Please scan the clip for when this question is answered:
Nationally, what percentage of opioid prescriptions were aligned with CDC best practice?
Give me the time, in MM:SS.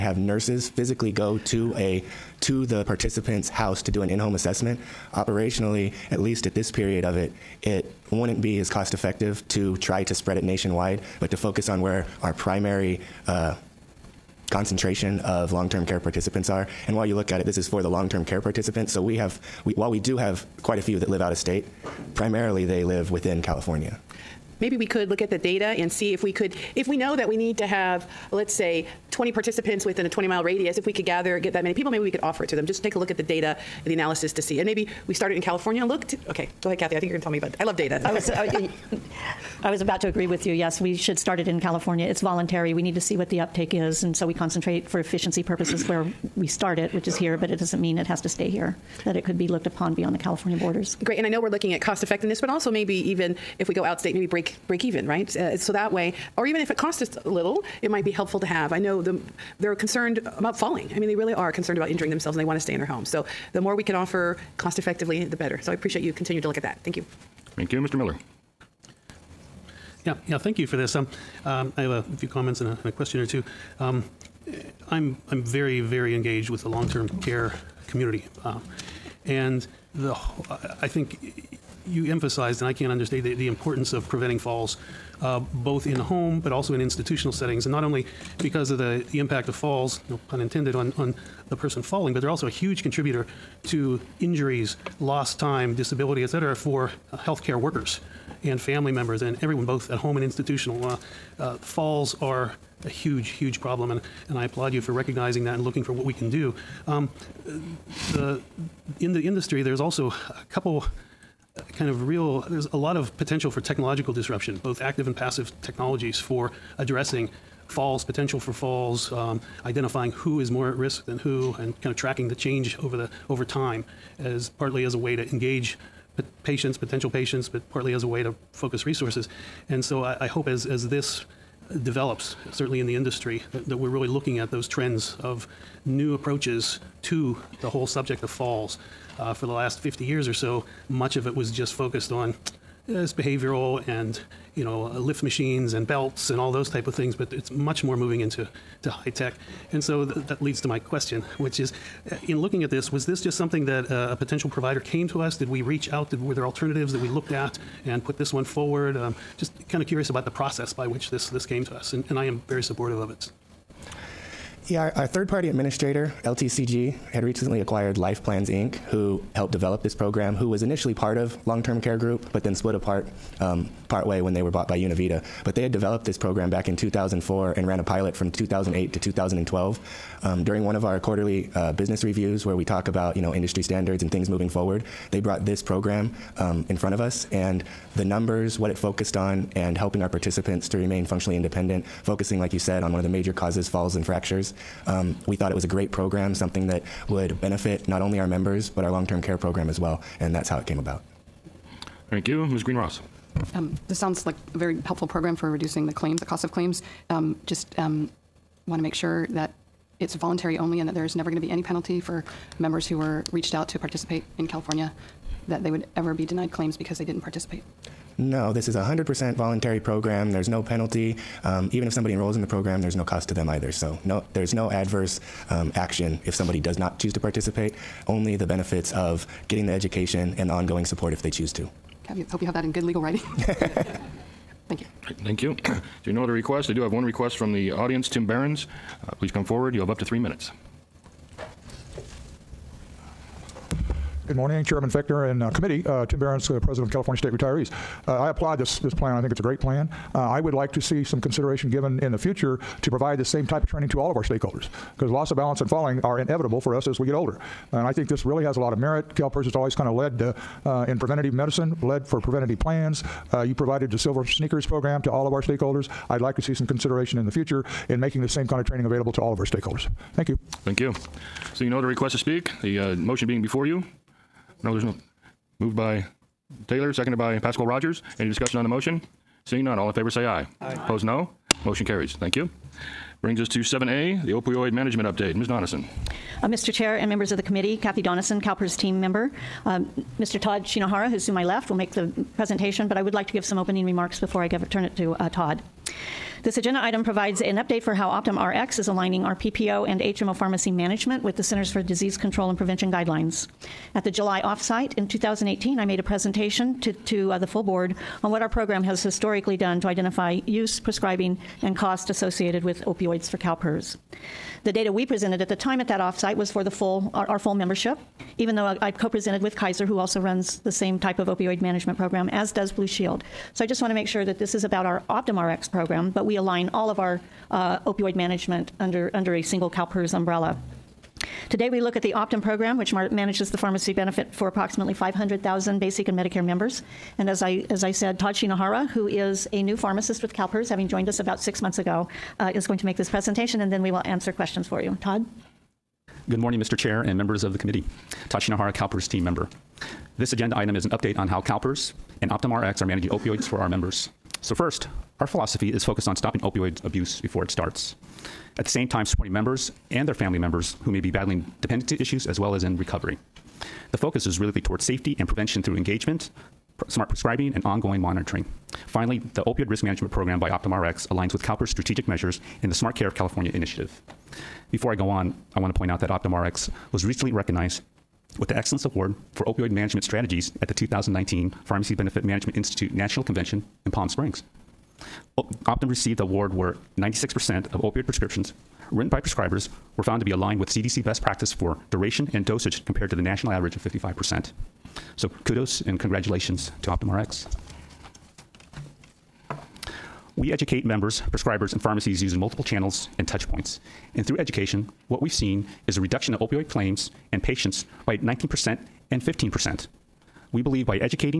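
06:33.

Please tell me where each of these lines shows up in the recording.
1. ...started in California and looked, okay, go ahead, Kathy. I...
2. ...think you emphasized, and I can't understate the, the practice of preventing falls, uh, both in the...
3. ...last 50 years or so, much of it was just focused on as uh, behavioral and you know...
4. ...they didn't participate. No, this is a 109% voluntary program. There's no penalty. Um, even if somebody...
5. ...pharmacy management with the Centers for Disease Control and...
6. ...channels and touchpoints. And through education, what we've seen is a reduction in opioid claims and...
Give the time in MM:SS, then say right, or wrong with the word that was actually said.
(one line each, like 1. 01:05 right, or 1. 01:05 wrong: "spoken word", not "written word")
1. 00:35 right
2. 01:20 wrong: "importance", not "practice"
3. 02:19 right
4. 03:36 wrong: "100", not "109"
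5. 05:00 right
6. 06:42 right.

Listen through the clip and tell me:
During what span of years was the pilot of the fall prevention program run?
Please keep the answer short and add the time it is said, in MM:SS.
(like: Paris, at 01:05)
2008 to 2012, at 02:58.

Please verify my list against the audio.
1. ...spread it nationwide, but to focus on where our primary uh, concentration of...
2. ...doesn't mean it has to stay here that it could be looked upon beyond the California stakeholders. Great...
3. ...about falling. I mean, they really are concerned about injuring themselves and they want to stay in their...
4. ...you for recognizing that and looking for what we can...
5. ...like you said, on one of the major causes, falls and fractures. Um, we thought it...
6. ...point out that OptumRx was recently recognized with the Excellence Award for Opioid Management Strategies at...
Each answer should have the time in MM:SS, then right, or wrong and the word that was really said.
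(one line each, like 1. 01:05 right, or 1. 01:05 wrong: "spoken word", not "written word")
1. 00:10 right
2. 00:47 wrong: "borders", not "stakeholders"
3. 01:00 right
4. 01:44 right
5. 03:12 right
6. 06:15 right.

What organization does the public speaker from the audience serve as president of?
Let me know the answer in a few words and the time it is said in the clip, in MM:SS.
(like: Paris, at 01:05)
California State Retirees, at 04:06.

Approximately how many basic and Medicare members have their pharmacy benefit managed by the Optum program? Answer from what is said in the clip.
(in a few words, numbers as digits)
500,000.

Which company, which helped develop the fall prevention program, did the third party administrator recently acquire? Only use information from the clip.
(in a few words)
Life Plans Inc.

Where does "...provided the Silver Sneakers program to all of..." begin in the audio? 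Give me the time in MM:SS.
04:23.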